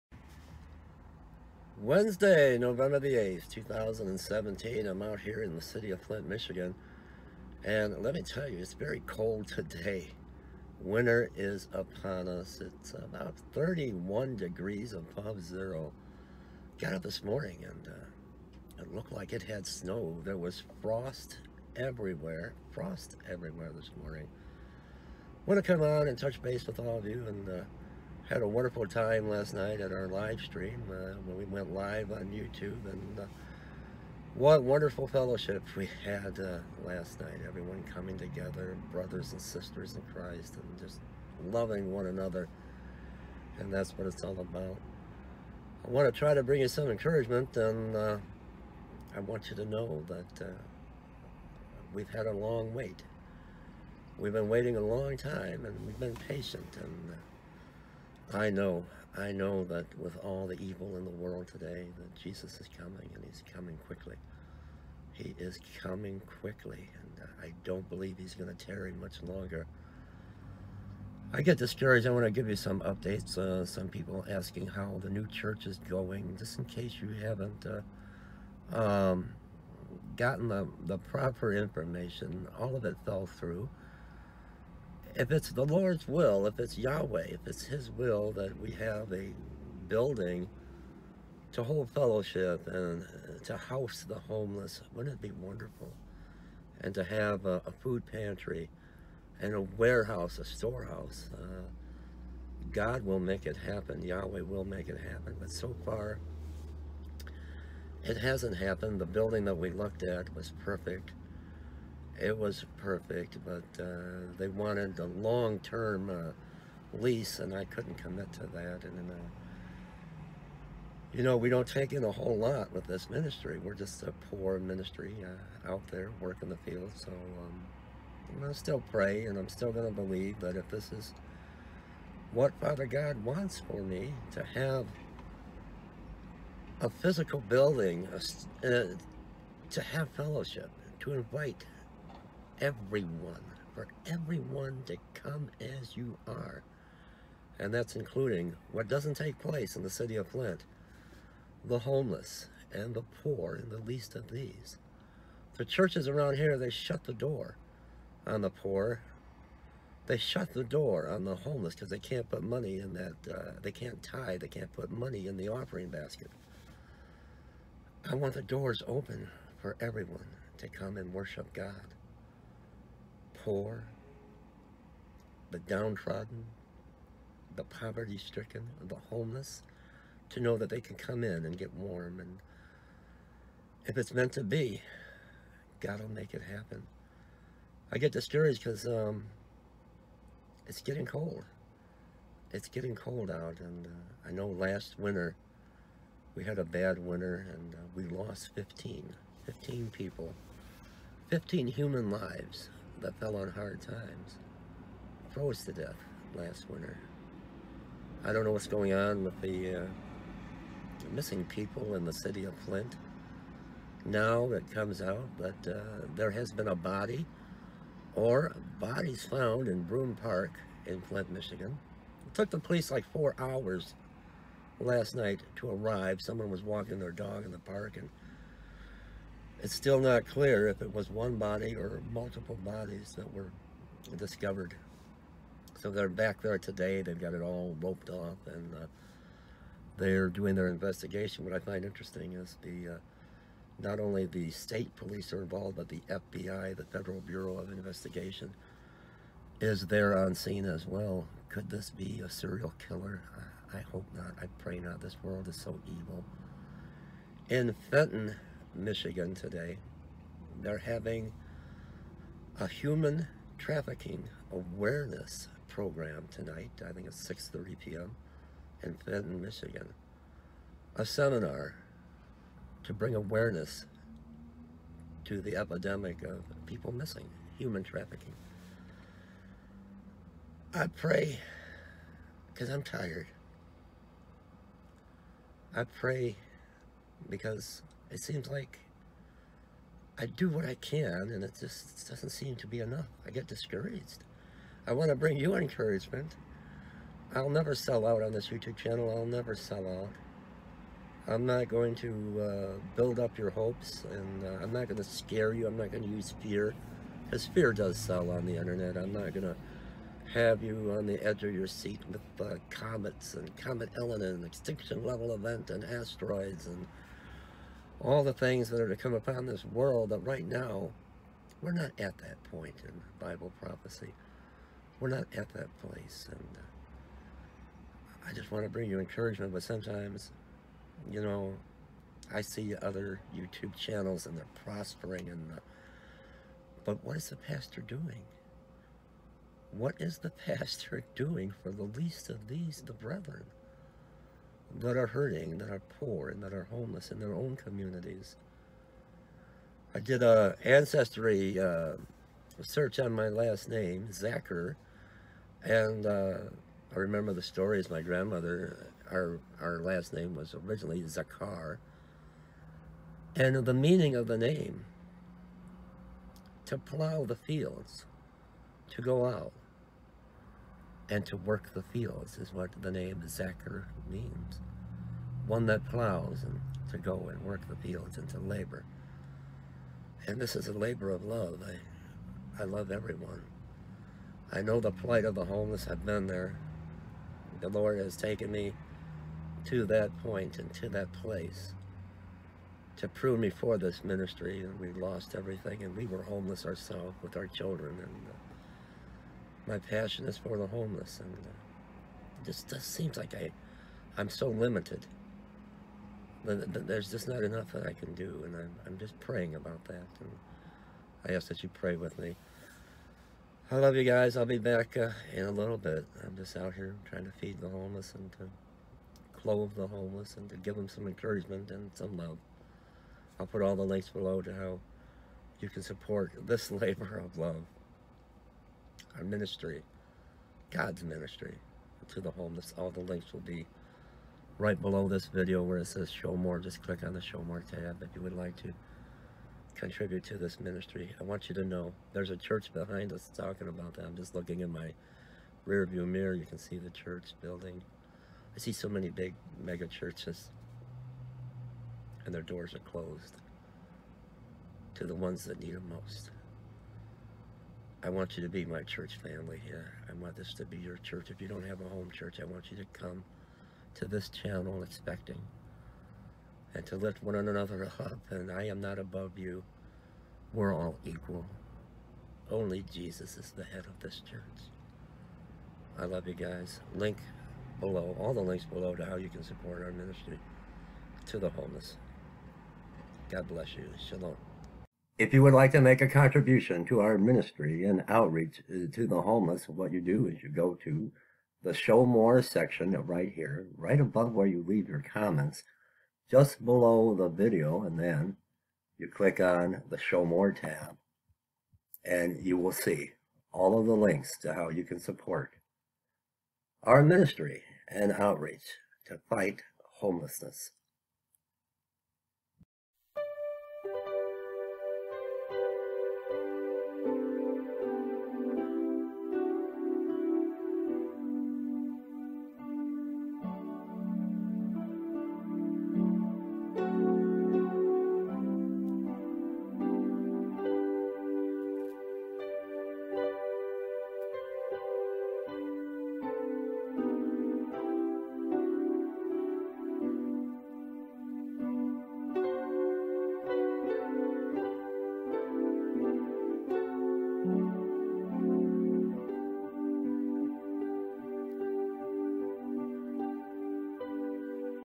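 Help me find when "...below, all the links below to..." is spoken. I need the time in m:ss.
7:57.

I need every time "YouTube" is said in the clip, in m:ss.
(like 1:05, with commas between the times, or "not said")
0:32, 4:58, 5:33.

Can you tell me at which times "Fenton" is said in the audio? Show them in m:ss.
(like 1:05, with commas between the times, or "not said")
4:17, 4:29.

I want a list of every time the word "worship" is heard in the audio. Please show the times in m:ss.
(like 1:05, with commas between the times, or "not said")
2:51.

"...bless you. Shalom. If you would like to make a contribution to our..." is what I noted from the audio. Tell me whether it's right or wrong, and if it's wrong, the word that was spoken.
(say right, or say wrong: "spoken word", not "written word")
right.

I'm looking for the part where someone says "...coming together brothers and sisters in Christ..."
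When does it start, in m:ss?
0:37.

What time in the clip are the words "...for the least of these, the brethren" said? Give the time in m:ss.
5:41.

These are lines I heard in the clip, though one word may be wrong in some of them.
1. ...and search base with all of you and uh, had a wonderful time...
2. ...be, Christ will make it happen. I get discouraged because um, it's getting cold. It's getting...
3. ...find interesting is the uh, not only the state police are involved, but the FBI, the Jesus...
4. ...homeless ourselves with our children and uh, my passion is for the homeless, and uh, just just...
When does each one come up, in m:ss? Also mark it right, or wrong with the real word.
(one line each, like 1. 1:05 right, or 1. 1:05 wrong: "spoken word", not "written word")
1. 0:26 wrong: "touch", not "search"
2. 3:04 wrong: "God", not "Christ"
3. 4:01 wrong: "Federal", not "Jesus"
4. 6:36 right.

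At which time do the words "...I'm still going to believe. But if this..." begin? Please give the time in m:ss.
2:09.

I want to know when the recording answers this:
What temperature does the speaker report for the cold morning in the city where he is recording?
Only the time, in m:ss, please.
0:13.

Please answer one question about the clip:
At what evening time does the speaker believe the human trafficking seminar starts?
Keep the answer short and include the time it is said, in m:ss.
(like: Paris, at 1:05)
6:30 p.m., at 4:27.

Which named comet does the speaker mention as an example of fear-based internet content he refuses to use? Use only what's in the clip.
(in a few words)
Comet Elenin.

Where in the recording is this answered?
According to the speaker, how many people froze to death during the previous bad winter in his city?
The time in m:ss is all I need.
3:17.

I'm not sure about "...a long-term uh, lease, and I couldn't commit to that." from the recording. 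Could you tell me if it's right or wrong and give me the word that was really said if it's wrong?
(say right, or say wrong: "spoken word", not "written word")
right.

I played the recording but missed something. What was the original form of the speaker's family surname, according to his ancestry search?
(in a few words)
Zakar.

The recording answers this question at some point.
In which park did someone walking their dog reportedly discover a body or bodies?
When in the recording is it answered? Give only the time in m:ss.
3:39.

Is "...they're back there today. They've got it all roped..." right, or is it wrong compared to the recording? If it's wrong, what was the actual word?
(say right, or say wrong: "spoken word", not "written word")
right.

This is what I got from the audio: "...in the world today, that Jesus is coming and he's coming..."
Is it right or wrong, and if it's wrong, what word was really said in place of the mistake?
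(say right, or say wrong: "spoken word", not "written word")
right.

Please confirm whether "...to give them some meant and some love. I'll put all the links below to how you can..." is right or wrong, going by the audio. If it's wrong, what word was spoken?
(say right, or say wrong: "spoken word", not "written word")
wrong: "encouragement", not "meant".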